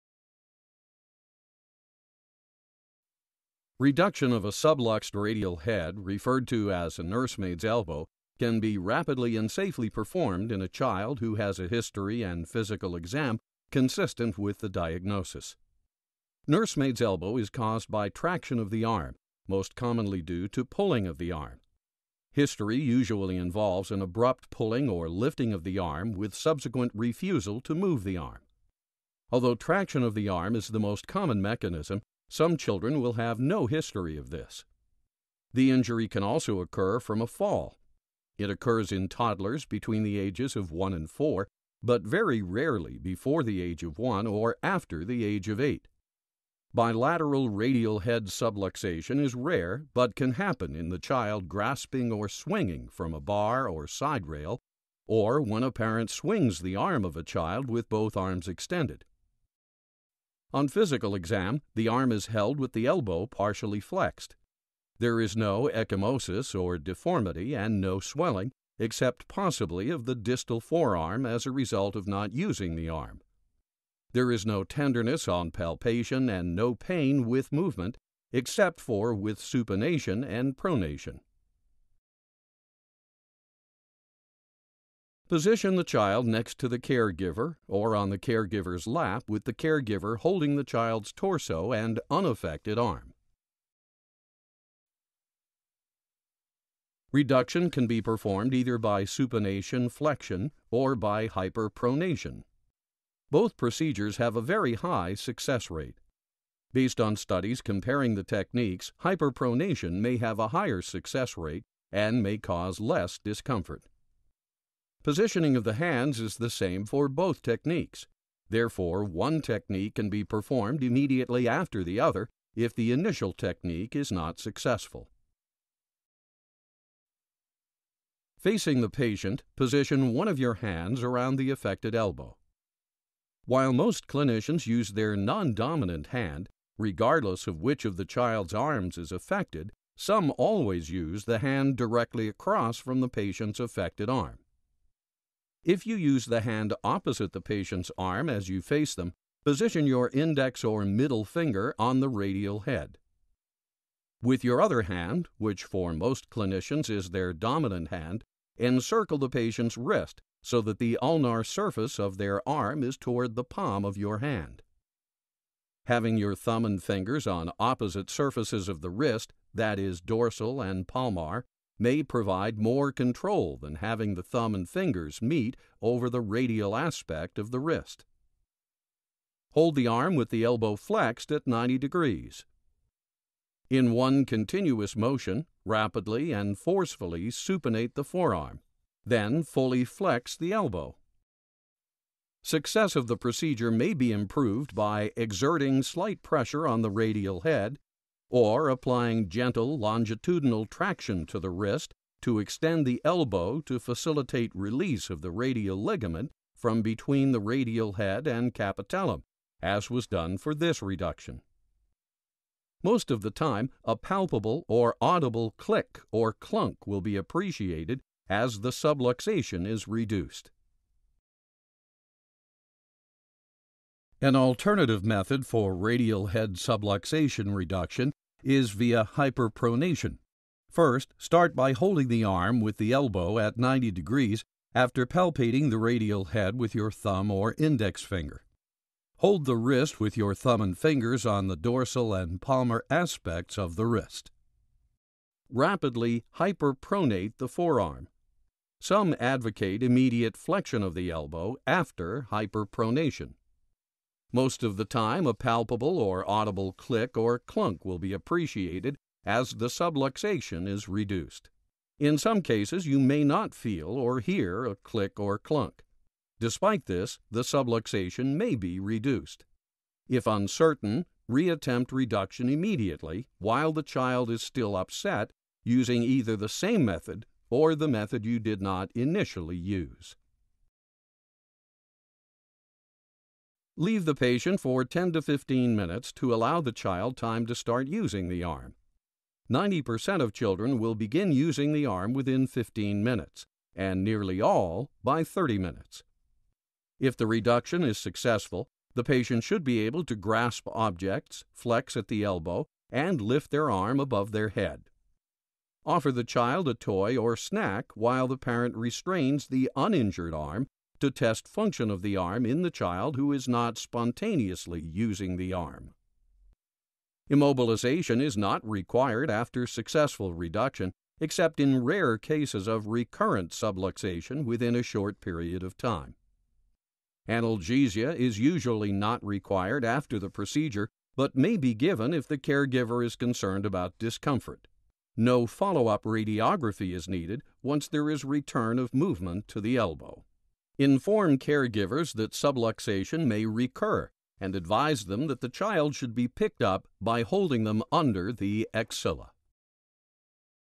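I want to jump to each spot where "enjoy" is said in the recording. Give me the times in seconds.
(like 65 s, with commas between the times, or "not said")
not said.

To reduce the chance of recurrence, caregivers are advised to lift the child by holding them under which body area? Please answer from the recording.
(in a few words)
the axilla.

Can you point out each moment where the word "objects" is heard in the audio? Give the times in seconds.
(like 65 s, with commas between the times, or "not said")
300 s.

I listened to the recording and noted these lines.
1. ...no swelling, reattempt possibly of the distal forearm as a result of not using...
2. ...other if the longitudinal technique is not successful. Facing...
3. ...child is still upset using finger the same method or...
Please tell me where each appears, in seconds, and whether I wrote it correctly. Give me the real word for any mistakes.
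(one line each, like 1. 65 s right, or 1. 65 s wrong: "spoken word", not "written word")
1. 67 s wrong: "except", not "reattempt"
2. 121 s wrong: "initial", not "longitudinal"
3. 273 s wrong: "either", not "finger".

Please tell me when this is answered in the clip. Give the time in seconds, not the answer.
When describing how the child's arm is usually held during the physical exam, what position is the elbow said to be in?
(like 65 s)
63 s.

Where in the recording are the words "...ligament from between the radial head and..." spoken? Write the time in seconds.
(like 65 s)
205 s.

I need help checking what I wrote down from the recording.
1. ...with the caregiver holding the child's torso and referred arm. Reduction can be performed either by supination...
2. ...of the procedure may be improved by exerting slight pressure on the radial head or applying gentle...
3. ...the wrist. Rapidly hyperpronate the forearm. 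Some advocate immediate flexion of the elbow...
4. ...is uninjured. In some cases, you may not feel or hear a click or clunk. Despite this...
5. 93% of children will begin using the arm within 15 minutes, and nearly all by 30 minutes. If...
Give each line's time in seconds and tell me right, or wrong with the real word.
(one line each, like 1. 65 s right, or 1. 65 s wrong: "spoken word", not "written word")
1. 89 s wrong: "unaffected", not "referred"
2. 192 s right
3. 243 s right
4. 260 s wrong: "reduced", not "uninjured"
5. 289 s wrong: "90", not "93".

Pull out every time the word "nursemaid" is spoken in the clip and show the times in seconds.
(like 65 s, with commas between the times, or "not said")
7 s, 16 s.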